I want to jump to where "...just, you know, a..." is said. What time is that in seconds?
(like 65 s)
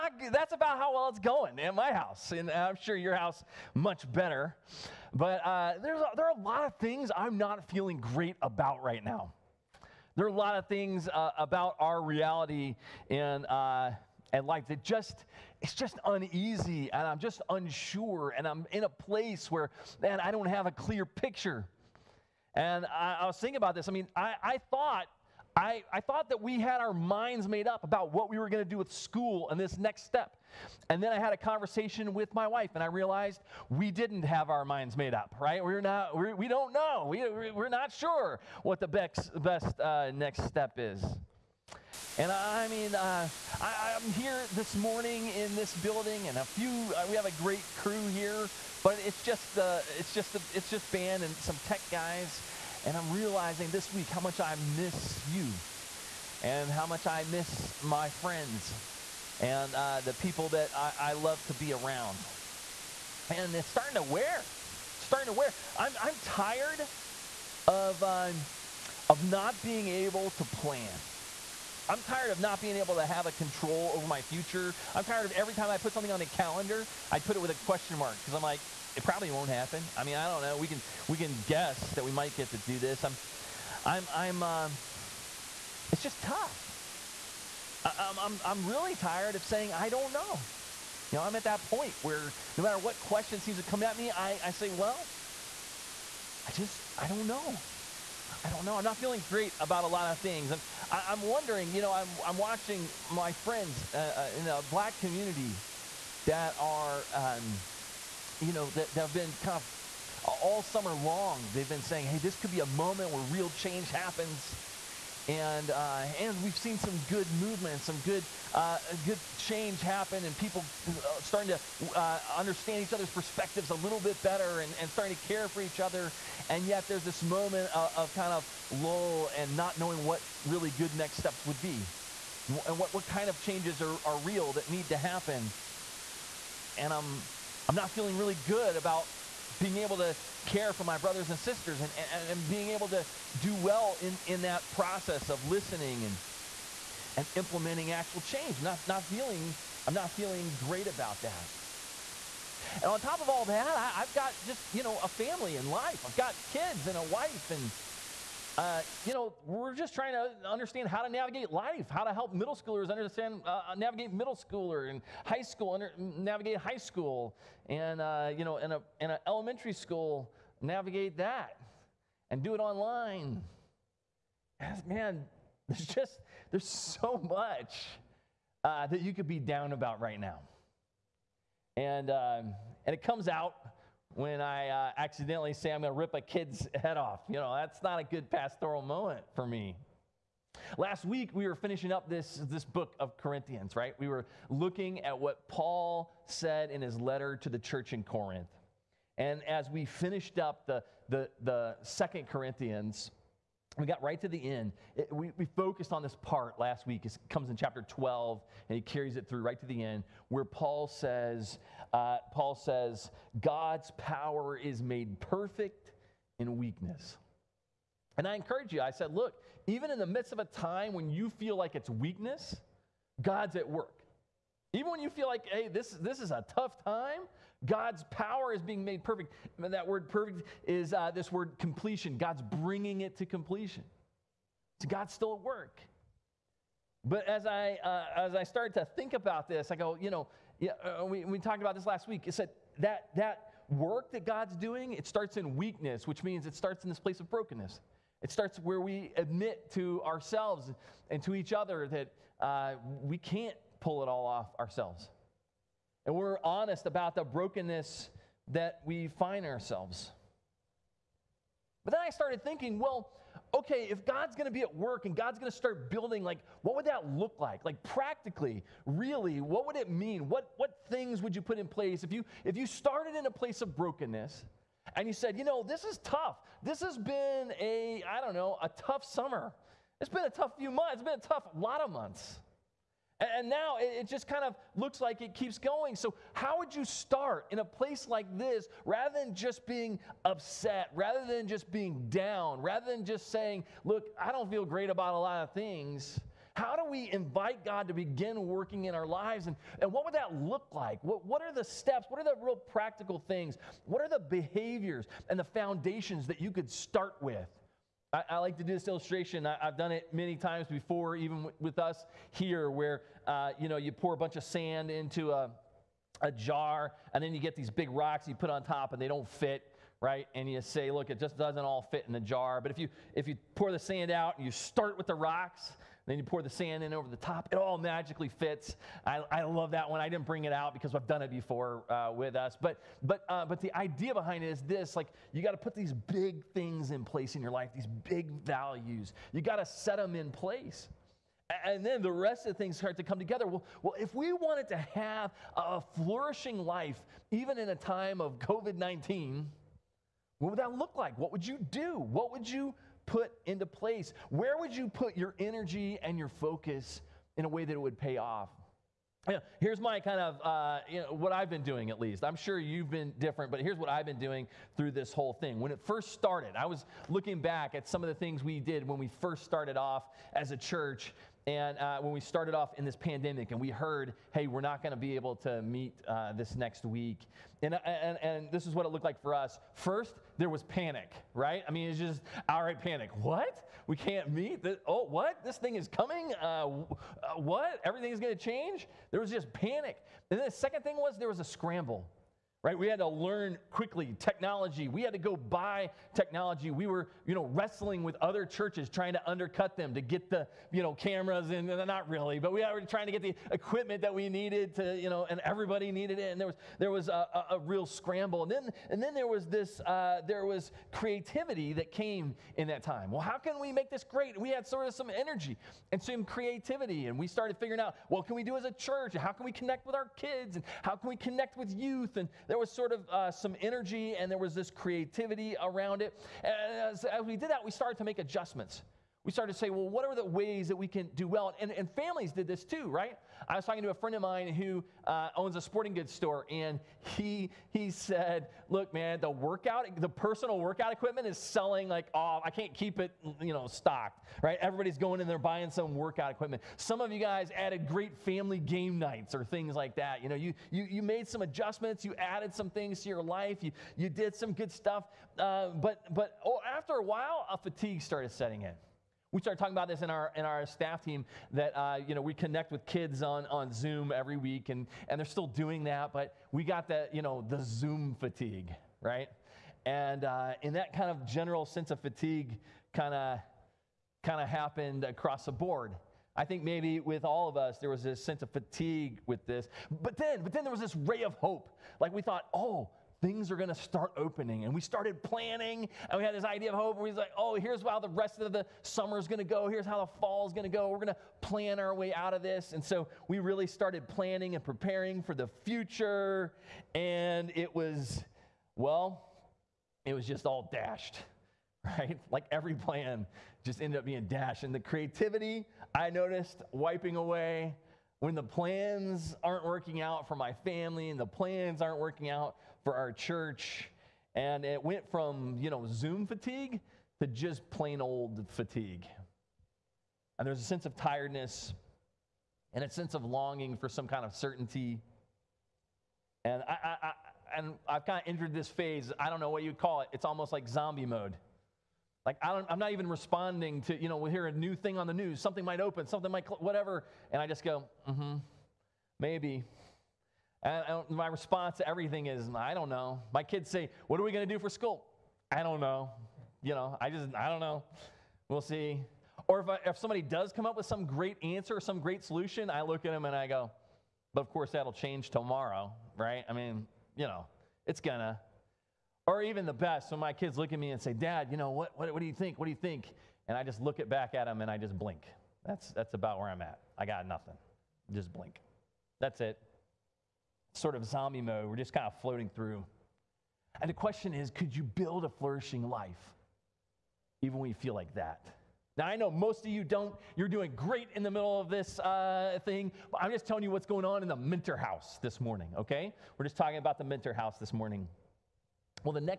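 154 s.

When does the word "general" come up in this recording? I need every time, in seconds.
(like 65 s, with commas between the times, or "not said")
471 s.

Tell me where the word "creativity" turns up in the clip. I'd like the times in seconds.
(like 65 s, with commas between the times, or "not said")
410 s, 416 s, 424 s, 504 s.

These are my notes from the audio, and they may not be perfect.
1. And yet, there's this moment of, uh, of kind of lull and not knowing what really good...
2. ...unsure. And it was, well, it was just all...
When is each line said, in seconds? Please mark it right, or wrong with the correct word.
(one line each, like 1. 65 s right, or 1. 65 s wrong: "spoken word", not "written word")
1. 126 s right
2. 495 s wrong: "future", not "unsure".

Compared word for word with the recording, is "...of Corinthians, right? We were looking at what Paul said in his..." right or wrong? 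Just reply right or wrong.
right.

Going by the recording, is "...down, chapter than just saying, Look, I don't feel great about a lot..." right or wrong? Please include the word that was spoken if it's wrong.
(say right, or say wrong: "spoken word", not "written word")
wrong: "rather", not "chapter".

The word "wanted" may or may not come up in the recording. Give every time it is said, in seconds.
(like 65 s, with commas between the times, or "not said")
344 s.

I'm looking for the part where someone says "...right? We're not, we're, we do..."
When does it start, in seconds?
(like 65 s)
35 s.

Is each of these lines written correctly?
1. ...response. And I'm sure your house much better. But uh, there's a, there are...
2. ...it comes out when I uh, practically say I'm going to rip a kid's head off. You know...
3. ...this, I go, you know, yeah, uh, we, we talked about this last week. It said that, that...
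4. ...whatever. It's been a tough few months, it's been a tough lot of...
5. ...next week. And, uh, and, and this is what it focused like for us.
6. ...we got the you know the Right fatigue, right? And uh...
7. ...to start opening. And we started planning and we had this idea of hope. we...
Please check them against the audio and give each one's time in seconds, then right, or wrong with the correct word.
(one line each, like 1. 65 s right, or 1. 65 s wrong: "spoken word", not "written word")
1. 1 s wrong: "house", not "response"
2. 182 s wrong: "accidentally", not "practically"
3. 239 s right
4. 279 s wrong: "summer", not "whatever"
5. 376 s wrong: "looked", not "focused"
6. 466 s wrong: "Zoom", not "Right"
7. 483 s right.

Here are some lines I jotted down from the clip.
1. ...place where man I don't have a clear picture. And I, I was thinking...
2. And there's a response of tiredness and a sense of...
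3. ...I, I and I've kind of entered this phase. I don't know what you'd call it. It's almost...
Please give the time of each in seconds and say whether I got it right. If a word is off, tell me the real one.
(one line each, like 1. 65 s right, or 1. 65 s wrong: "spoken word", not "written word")
1. 18 s right
2. 520 s wrong: "sense", not "response"
3. 526 s right.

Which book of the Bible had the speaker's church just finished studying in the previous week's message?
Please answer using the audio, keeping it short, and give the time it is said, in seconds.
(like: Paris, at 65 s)
2 Corinthians, at 201 s.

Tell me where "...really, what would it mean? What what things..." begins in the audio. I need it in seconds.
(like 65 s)
268 s.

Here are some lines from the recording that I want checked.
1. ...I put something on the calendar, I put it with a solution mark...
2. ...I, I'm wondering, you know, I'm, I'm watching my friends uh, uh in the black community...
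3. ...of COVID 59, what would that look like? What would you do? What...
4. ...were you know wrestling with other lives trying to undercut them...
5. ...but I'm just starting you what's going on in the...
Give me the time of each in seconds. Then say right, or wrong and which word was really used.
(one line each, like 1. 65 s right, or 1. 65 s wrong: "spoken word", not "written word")
1. 75 s wrong: "question", not "solution"
2. 100 s right
3. 348 s wrong: "19", not "59"
4. 396 s wrong: "churches", not "lives"
5. 583 s wrong: "telling", not "starting".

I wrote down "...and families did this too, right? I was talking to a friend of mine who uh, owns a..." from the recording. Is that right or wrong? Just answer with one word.
right.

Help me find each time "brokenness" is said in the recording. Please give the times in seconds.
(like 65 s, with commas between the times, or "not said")
247 s, 257 s, 273 s.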